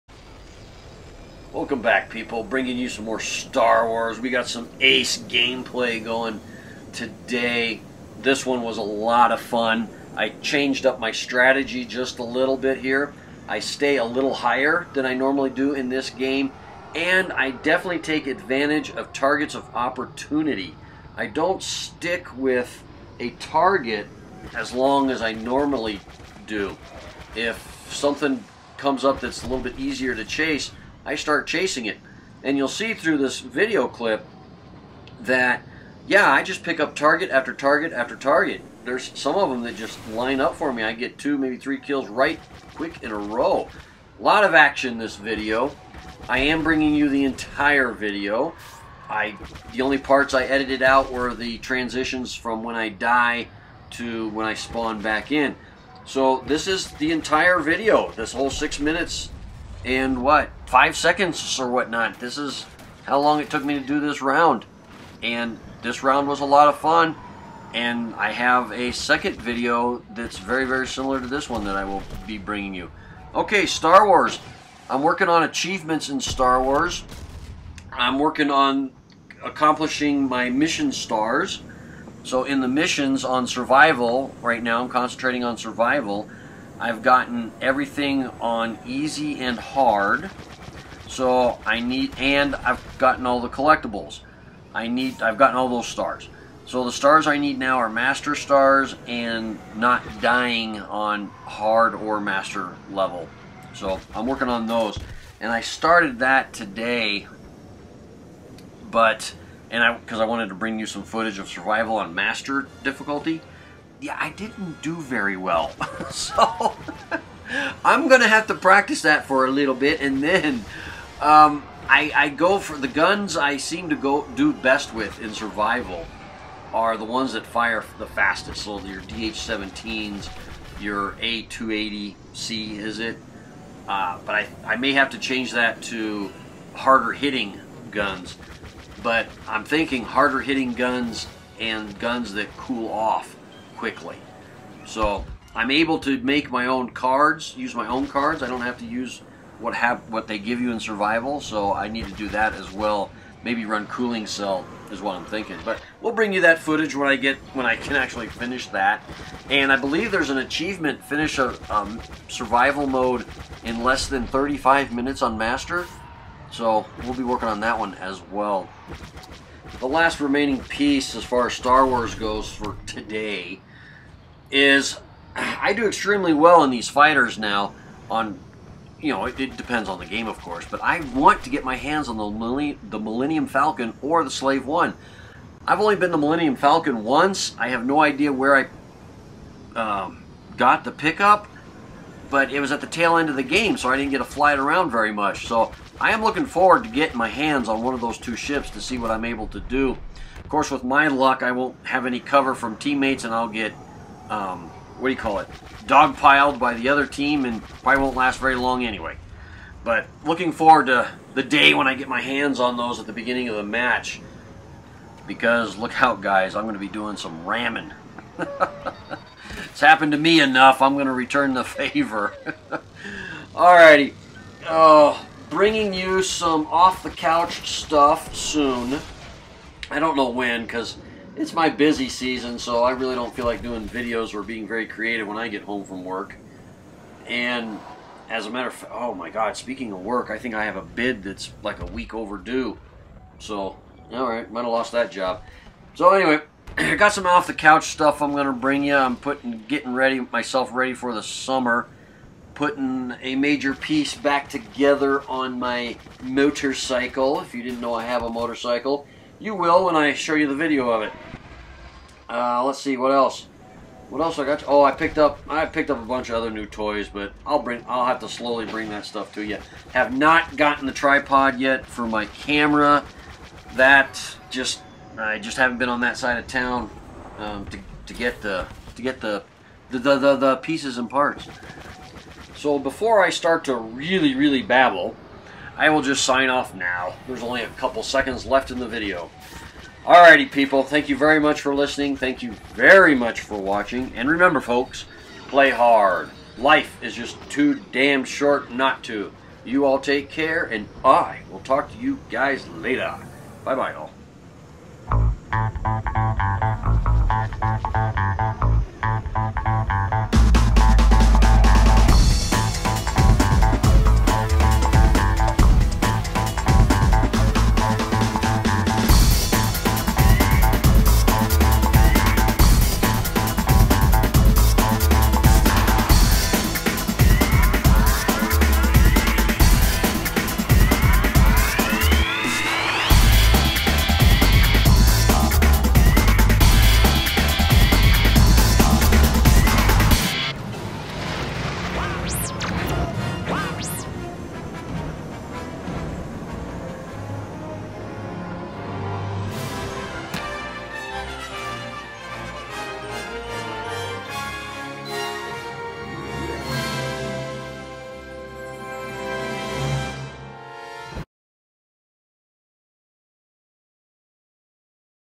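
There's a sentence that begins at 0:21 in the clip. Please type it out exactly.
I don't stick with a target as long as I normally do.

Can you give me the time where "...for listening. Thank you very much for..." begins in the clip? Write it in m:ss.
4:51.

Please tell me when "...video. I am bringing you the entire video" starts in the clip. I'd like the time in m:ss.
0:45.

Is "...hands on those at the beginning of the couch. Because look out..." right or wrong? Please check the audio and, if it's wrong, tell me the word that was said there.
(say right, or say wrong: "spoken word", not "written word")
wrong: "match", not "couch".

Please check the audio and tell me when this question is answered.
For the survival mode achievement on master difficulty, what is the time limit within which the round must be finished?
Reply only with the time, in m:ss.
2:44.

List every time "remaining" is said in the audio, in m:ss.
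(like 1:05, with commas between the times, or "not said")
2:50.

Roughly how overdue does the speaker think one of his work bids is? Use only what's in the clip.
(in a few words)
A week.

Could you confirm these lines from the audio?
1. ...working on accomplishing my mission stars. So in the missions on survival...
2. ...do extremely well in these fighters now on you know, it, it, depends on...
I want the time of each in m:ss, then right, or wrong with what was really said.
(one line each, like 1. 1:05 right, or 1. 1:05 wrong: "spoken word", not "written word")
1. 1:18 right
2. 2:55 right.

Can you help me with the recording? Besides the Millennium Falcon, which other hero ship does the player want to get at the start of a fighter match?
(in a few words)
Slave One.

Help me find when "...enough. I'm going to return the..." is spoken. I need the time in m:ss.
3:40.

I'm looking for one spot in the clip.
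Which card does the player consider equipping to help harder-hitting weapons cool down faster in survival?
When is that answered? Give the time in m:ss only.
2:33.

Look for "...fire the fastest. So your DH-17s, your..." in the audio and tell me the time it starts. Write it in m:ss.
2:07.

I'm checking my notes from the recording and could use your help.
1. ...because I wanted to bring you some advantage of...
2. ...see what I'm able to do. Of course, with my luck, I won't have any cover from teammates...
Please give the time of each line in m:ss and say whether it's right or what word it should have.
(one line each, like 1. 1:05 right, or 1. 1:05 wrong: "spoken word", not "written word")
1. 1:49 wrong: "footage", not "advantage"
2. 3:18 right.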